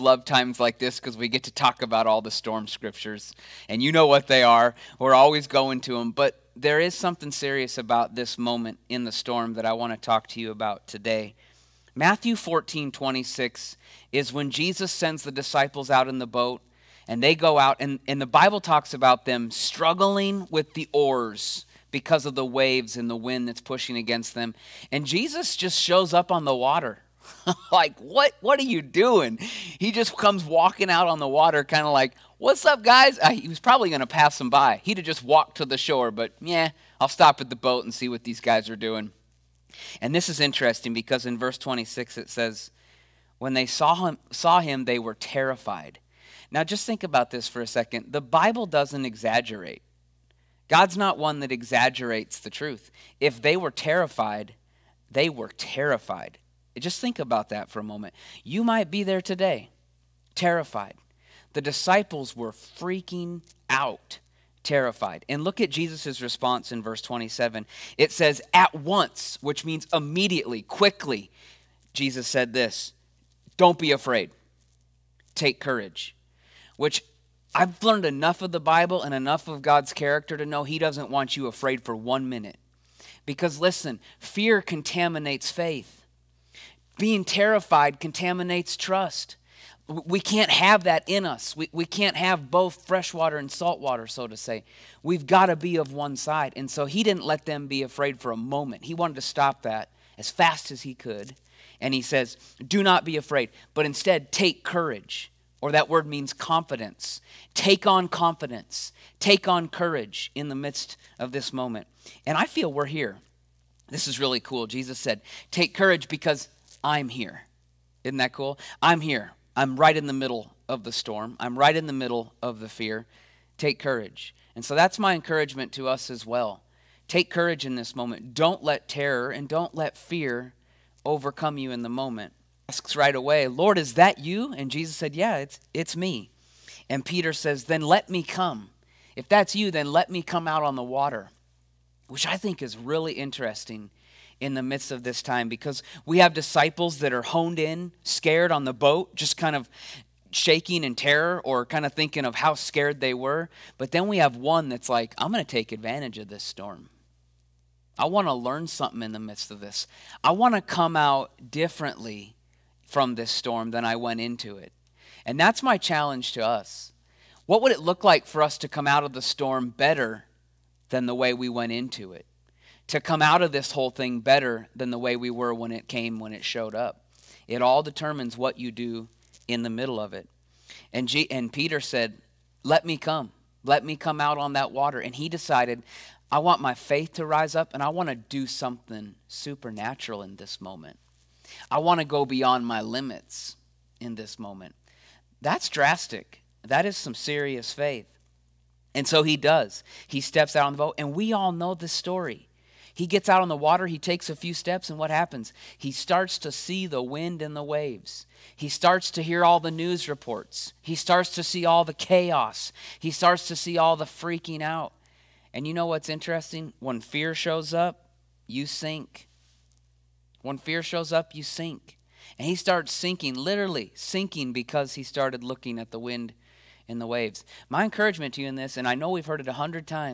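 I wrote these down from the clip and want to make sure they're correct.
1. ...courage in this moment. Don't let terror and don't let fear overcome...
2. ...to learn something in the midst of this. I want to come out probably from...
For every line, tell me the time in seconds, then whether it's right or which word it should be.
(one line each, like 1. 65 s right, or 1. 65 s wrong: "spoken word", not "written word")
1. 127 s right
2. 158 s wrong: "differently", not "probably".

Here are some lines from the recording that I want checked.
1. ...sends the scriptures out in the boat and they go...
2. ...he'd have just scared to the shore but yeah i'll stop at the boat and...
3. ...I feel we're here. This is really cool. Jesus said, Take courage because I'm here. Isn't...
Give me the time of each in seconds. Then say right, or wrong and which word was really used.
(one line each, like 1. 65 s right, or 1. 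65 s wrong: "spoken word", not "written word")
1. 14 s wrong: "disciples", not "scriptures"
2. 34 s wrong: "walked", not "scared"
3. 112 s right.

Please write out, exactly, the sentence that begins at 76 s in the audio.
Which I've learned enough of the Bible and enough of God's character to know He doesn't want you afraid for one minute.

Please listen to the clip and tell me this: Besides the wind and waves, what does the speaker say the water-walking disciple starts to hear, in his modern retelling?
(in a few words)
news reports.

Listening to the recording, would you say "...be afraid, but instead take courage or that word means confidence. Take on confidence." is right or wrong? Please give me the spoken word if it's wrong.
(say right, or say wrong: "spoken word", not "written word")
right.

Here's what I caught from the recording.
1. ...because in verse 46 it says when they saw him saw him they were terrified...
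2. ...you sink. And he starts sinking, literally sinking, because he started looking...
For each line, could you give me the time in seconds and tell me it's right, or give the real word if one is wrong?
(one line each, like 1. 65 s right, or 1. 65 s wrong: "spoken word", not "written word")
1. 40 s wrong: "26", not "46"
2. 221 s right.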